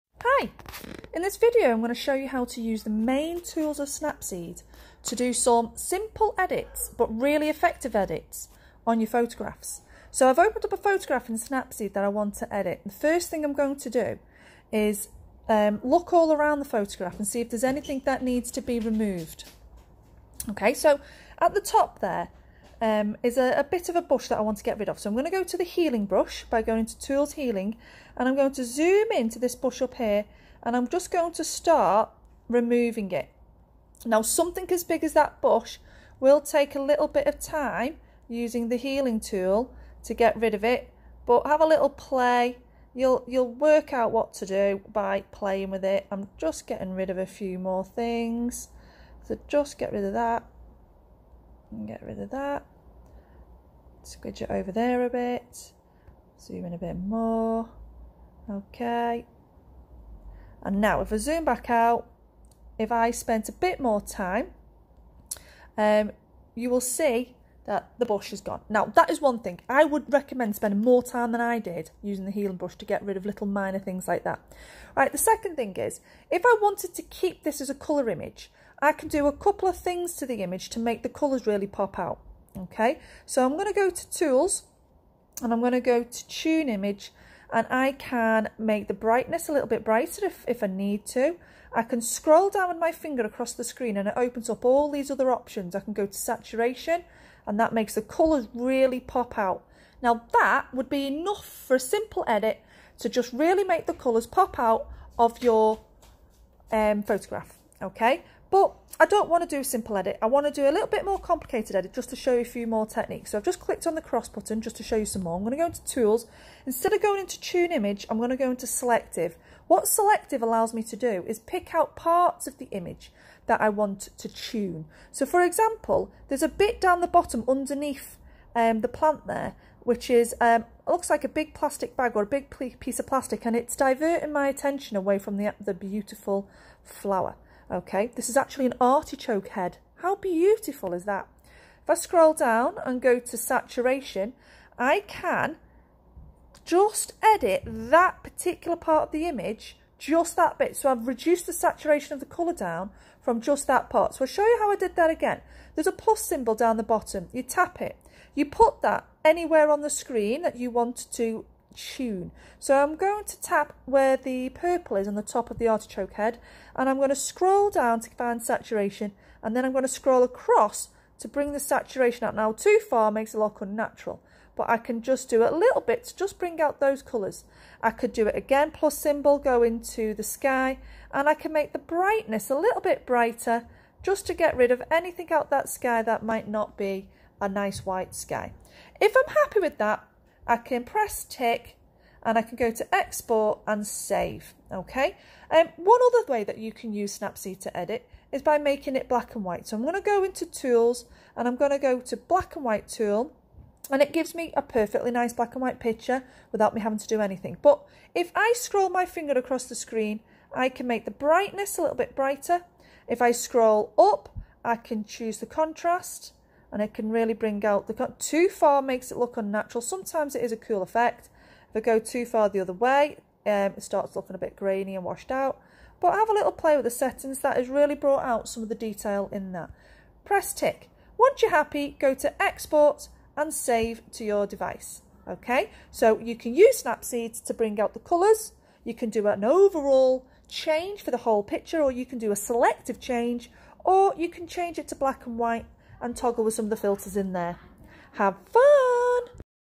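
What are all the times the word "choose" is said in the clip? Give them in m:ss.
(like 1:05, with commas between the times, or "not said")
3:35.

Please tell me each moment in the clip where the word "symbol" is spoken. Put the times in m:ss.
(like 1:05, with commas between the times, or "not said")
2:36, 2:58.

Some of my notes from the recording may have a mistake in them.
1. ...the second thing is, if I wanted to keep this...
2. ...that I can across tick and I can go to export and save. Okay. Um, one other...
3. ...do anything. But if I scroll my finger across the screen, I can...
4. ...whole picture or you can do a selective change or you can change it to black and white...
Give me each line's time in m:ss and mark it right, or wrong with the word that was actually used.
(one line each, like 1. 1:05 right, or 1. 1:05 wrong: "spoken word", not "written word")
1. 1:15 right
2. 3:09 wrong: "press", not "across"
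3. 3:27 right
4. 4:01 right.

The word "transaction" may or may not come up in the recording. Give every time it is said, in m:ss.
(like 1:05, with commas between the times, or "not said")
not said.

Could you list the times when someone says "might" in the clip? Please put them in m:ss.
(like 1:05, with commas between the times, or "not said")
3:06.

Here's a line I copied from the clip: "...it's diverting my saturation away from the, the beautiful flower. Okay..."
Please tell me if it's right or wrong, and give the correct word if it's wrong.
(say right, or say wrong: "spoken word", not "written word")
wrong: "attention", not "saturation".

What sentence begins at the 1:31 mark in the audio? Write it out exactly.
I can scroll down with my finger across the screen and it opens up all these other options.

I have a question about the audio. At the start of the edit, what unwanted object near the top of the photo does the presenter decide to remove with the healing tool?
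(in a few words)
A bush.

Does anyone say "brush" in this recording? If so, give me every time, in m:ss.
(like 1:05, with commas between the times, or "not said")
0:26, 1:12.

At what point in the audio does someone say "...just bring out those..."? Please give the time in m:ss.
2:56.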